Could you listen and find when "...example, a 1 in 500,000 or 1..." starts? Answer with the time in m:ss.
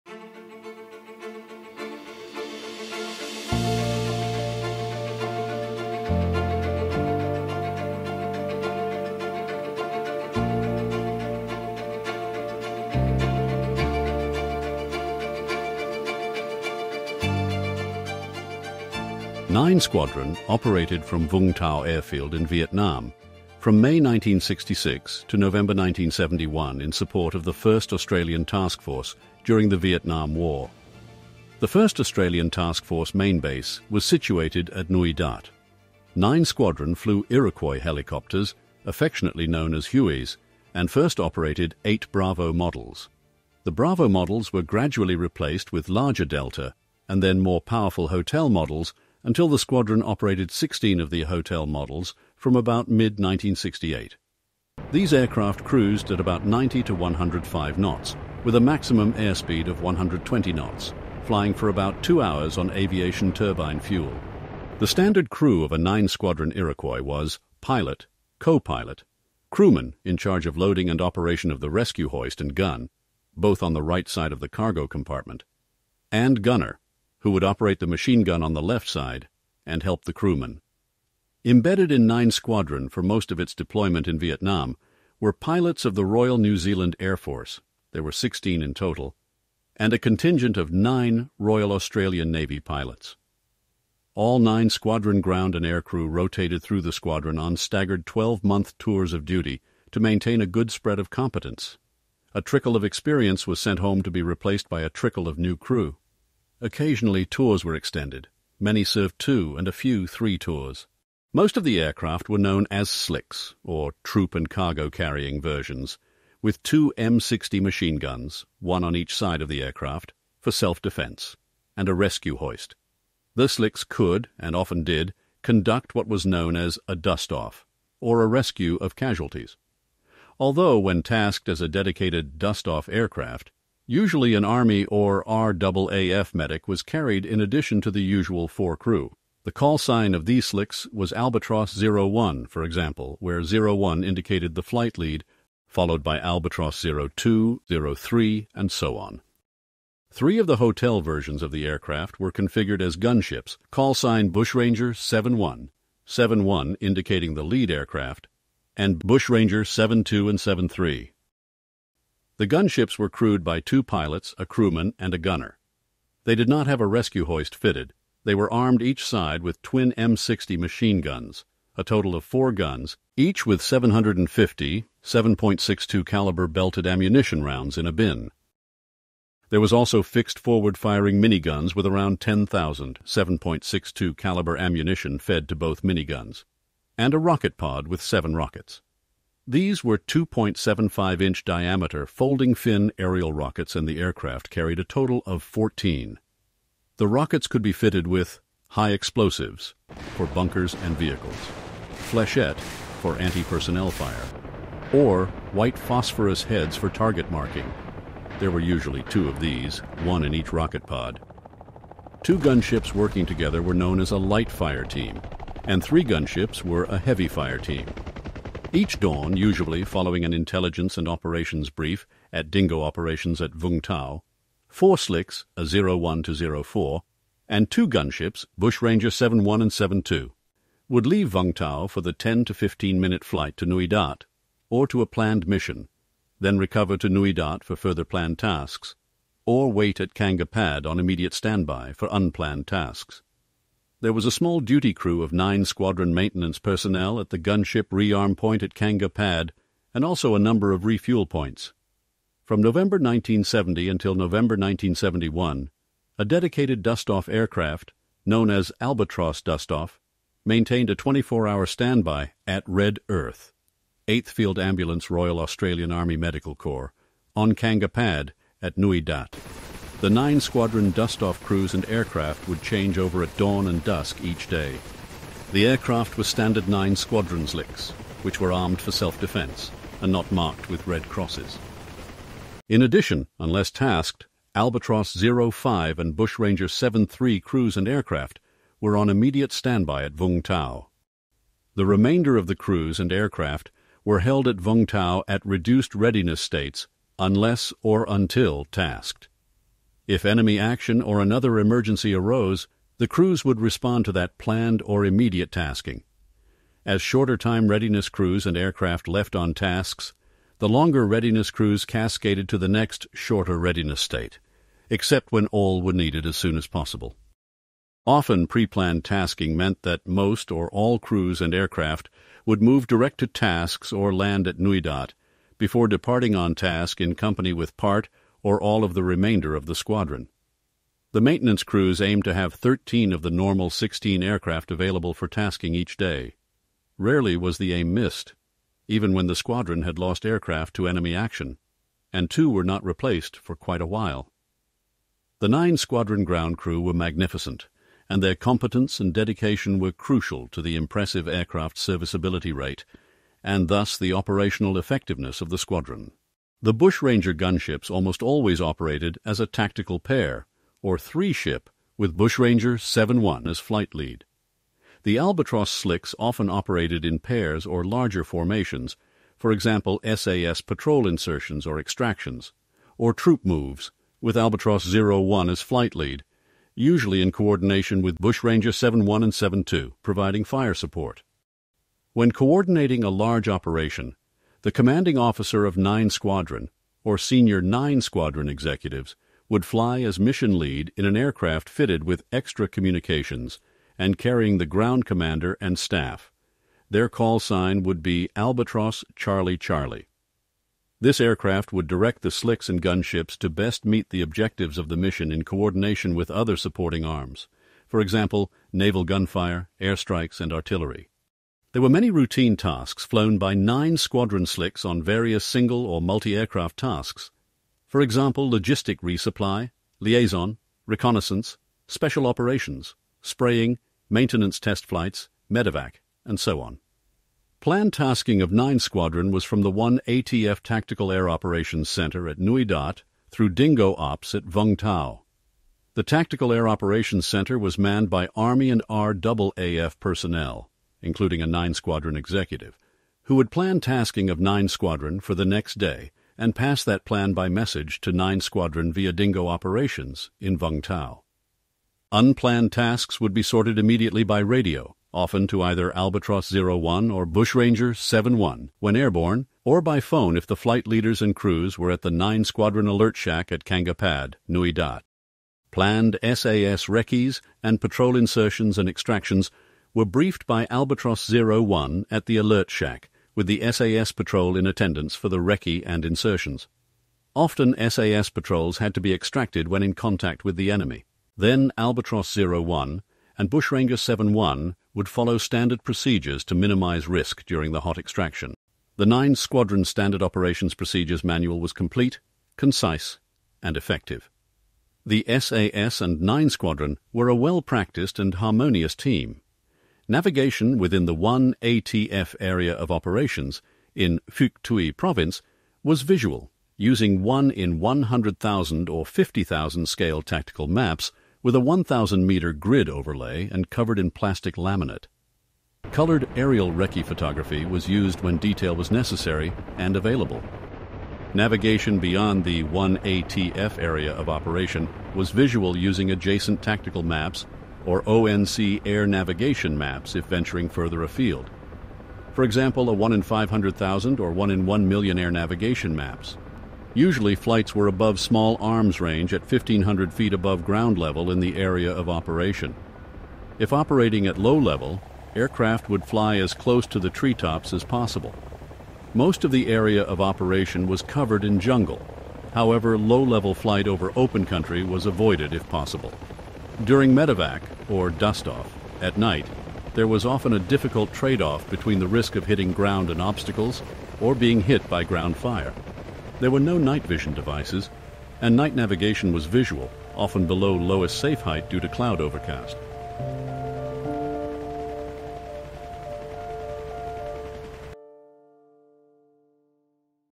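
8:52.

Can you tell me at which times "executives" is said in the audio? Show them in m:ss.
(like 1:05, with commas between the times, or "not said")
6:28, 7:22.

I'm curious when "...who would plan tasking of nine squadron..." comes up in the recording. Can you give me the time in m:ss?
7:23.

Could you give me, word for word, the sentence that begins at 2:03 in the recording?
The slicks could, and often did, conduct what was known as a dust-off, or a rescue of casualties.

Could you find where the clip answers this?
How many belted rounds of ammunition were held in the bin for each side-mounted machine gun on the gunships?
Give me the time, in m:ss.
2:53.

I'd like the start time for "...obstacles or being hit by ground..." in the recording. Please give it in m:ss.
9:23.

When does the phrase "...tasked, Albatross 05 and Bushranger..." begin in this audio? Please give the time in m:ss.
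4:43.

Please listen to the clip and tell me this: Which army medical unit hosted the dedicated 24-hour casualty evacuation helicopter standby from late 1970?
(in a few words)
8th Field Ambulance.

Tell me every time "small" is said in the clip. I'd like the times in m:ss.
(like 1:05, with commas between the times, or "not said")
4:04, 8:58.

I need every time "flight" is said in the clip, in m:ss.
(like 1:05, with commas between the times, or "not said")
2:24, 3:53, 6:03, 6:15, 7:04, 7:40, 8:57, 9:13.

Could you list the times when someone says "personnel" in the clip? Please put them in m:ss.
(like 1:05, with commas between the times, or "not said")
3:23, 4:06, 7:20.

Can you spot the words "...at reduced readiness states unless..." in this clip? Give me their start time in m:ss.
4:55.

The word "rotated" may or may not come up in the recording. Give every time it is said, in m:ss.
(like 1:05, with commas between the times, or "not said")
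1:36.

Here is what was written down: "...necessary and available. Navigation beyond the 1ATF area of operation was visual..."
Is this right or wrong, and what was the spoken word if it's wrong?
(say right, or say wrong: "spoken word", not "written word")
right.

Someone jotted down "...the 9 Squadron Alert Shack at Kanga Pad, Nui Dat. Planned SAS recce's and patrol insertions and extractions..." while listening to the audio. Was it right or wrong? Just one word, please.
right.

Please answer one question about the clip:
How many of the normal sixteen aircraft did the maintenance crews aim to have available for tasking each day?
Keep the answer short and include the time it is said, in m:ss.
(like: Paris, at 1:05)
13, at 5:32.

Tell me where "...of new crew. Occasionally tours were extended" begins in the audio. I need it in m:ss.
1:45.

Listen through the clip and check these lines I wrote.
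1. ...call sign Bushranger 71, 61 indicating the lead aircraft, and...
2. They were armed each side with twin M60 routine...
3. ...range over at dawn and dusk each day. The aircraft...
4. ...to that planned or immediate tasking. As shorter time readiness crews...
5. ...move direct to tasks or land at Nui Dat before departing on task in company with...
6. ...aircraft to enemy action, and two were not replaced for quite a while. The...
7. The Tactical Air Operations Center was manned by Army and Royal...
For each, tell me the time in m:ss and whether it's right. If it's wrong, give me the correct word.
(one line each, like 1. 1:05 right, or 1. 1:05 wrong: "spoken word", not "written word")
1. 2:33 wrong: "71", not "61"
2. 2:48 wrong: "machine", not "routine"
3. 4:32 wrong: "change", not "range"
4. 5:04 right
5. 5:22 right
6. 5:40 right
7. 7:15 wrong: "RAAF", not "Royal".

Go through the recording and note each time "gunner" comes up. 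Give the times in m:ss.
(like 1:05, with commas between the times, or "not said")
1:16, 2:45.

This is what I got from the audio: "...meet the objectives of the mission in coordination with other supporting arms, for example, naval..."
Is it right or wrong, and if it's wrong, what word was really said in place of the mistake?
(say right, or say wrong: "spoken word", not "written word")
right.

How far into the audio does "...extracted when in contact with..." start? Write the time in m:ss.
7:59.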